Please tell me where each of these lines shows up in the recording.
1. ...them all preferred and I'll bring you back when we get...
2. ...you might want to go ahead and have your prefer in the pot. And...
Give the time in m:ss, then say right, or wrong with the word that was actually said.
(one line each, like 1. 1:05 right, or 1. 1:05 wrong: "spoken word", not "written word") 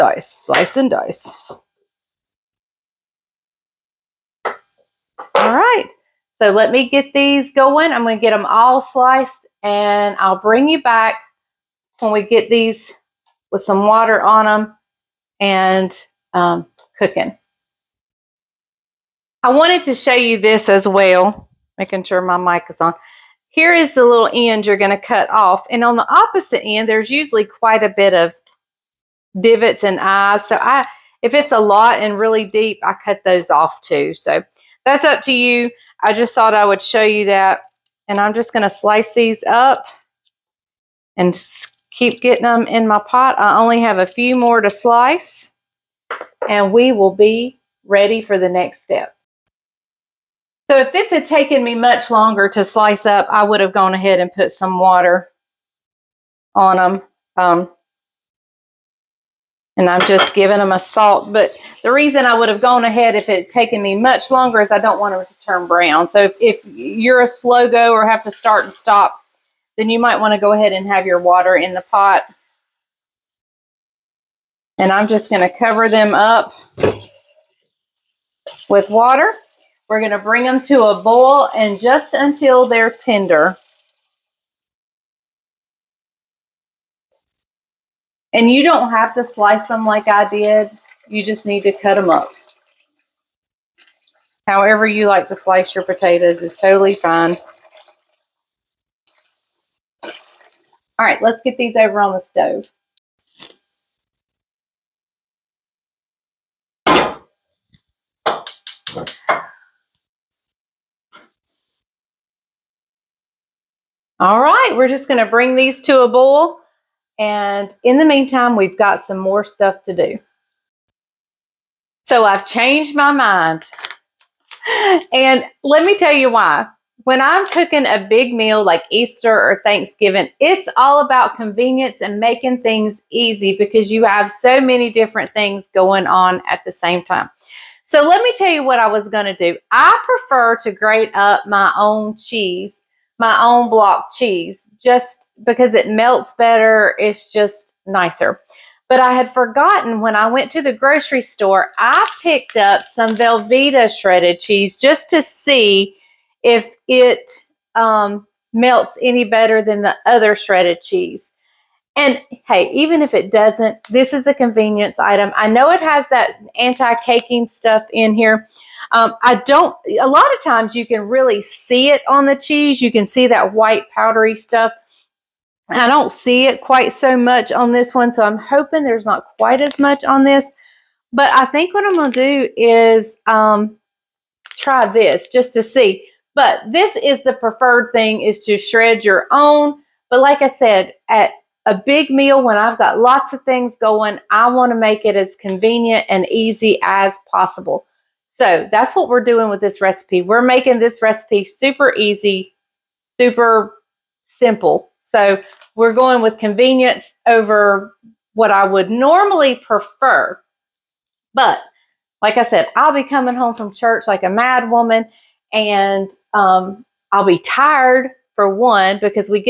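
1. 0:08 wrong: "sliced", not "preferred"
2. 1:09 wrong: "water", not "prefer".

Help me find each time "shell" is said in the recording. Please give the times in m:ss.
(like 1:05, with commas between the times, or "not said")
not said.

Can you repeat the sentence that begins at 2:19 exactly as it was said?
I prefer to grate up my own cheese my own block cheese just because it melts better.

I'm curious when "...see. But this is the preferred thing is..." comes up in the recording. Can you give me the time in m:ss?
3:05.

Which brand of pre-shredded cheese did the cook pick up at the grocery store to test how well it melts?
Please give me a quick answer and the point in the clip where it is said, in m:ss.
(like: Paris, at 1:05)
Velveeta, at 2:33.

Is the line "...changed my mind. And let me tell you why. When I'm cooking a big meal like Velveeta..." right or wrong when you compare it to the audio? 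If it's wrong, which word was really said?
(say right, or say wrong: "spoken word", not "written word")
wrong: "Easter", not "Velveeta".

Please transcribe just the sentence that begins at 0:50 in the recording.
So if this had taken me much longer to slice up, I would have gone ahead and put some water on them.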